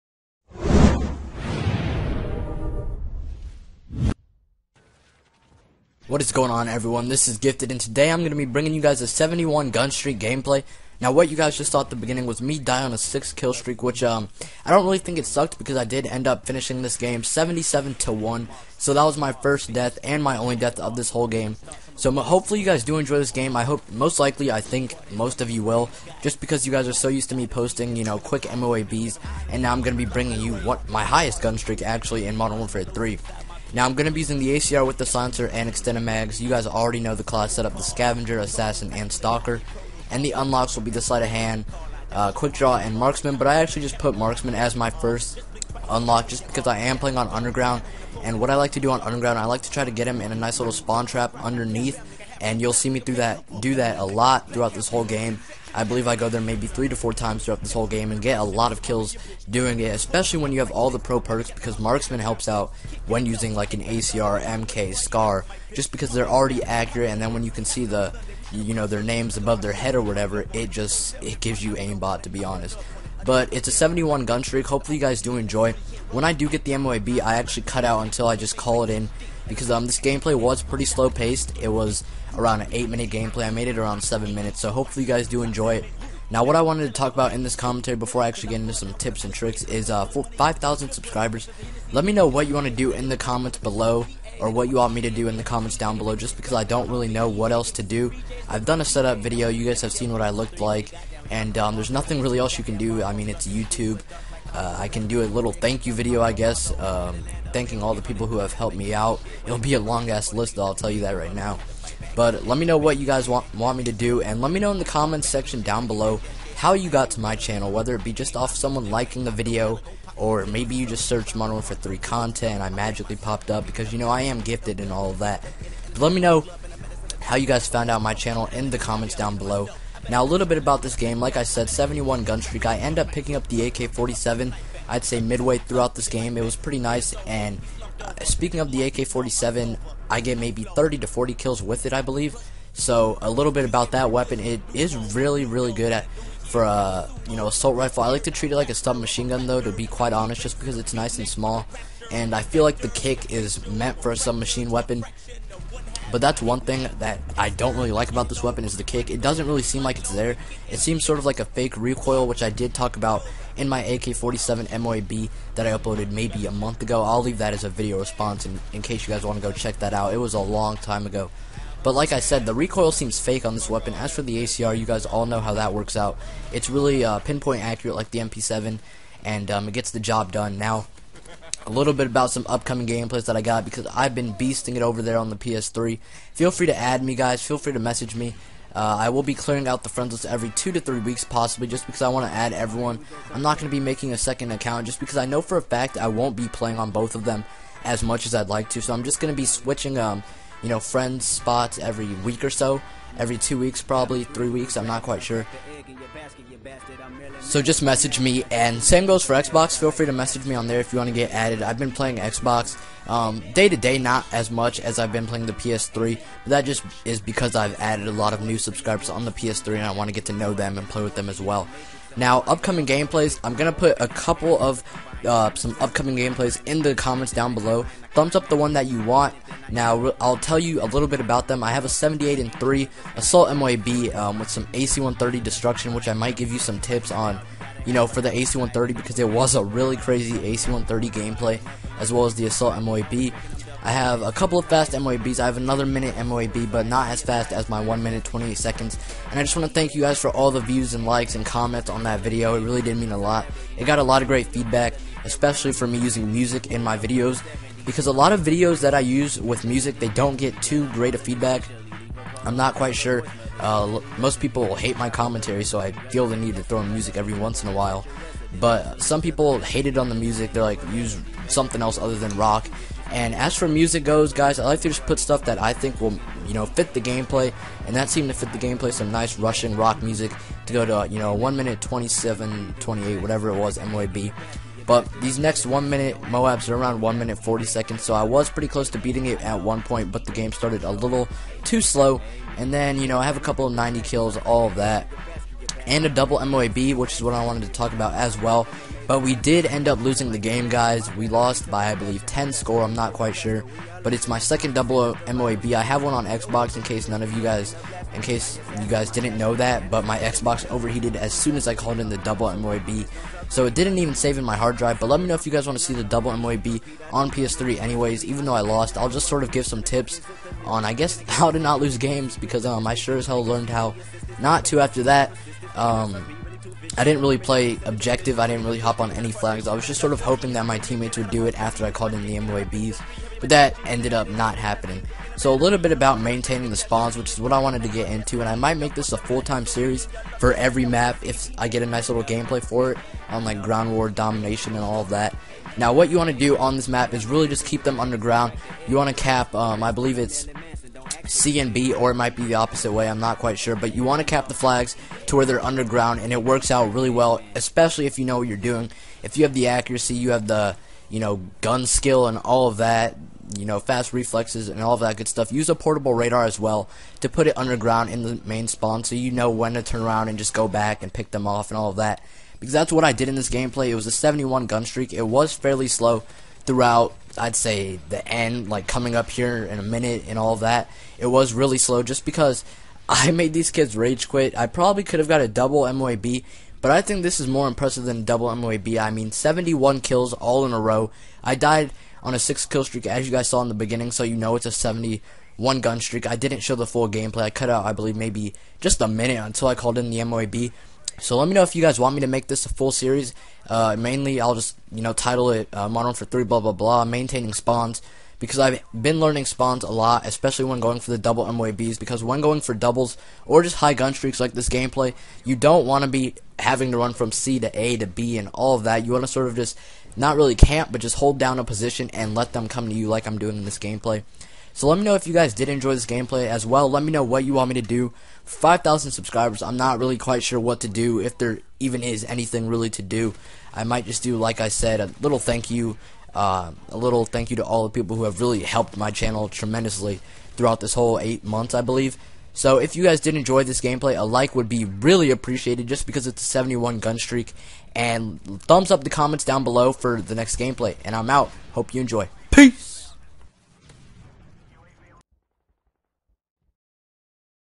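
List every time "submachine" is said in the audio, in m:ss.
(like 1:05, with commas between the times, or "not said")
2:28, 2:34.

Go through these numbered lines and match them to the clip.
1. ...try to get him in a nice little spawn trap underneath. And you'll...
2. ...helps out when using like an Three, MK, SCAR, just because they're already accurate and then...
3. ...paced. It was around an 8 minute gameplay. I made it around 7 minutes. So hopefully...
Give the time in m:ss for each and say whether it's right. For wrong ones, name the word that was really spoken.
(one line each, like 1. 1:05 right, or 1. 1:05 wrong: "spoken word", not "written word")
1. 0:49 right
2. 1:02 wrong: "ACR", not "Three"
3. 1:21 right.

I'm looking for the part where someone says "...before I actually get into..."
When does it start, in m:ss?
1:27.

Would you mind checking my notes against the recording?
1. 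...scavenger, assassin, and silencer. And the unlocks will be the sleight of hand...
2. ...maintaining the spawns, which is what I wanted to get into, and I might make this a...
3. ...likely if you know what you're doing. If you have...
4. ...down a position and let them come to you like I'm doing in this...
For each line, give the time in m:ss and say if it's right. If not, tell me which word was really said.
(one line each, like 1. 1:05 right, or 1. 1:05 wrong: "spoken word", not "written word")
1. 0:37 wrong: "stalker", not "silencer"
2. 5:36 right
3. 5:57 wrong: "especially", not "likely"
4. 7:01 right.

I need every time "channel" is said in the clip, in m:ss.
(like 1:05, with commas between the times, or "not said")
1:57, 2:08, 7:19.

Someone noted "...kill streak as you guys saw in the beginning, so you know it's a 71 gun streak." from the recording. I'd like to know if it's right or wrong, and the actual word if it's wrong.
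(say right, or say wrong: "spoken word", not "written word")
right.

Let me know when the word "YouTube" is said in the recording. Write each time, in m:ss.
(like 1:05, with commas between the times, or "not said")
1:43.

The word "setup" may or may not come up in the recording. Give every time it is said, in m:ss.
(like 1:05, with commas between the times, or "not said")
0:37, 1:38.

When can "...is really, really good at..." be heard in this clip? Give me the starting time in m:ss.
2:24.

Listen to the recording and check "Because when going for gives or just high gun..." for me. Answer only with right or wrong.
wrong.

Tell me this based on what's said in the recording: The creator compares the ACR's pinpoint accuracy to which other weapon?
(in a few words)
MP7.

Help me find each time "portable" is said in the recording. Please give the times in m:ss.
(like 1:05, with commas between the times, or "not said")
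6:05.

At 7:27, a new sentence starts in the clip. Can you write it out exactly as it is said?
And thumbs up the comments down below for the next gameplay.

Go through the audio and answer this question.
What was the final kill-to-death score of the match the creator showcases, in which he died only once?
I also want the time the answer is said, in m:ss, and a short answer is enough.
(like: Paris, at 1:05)
77 to 1, at 0:17.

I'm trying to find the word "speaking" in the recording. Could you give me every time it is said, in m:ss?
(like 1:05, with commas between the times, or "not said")
2:18.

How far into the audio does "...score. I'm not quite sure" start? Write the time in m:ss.
5:02.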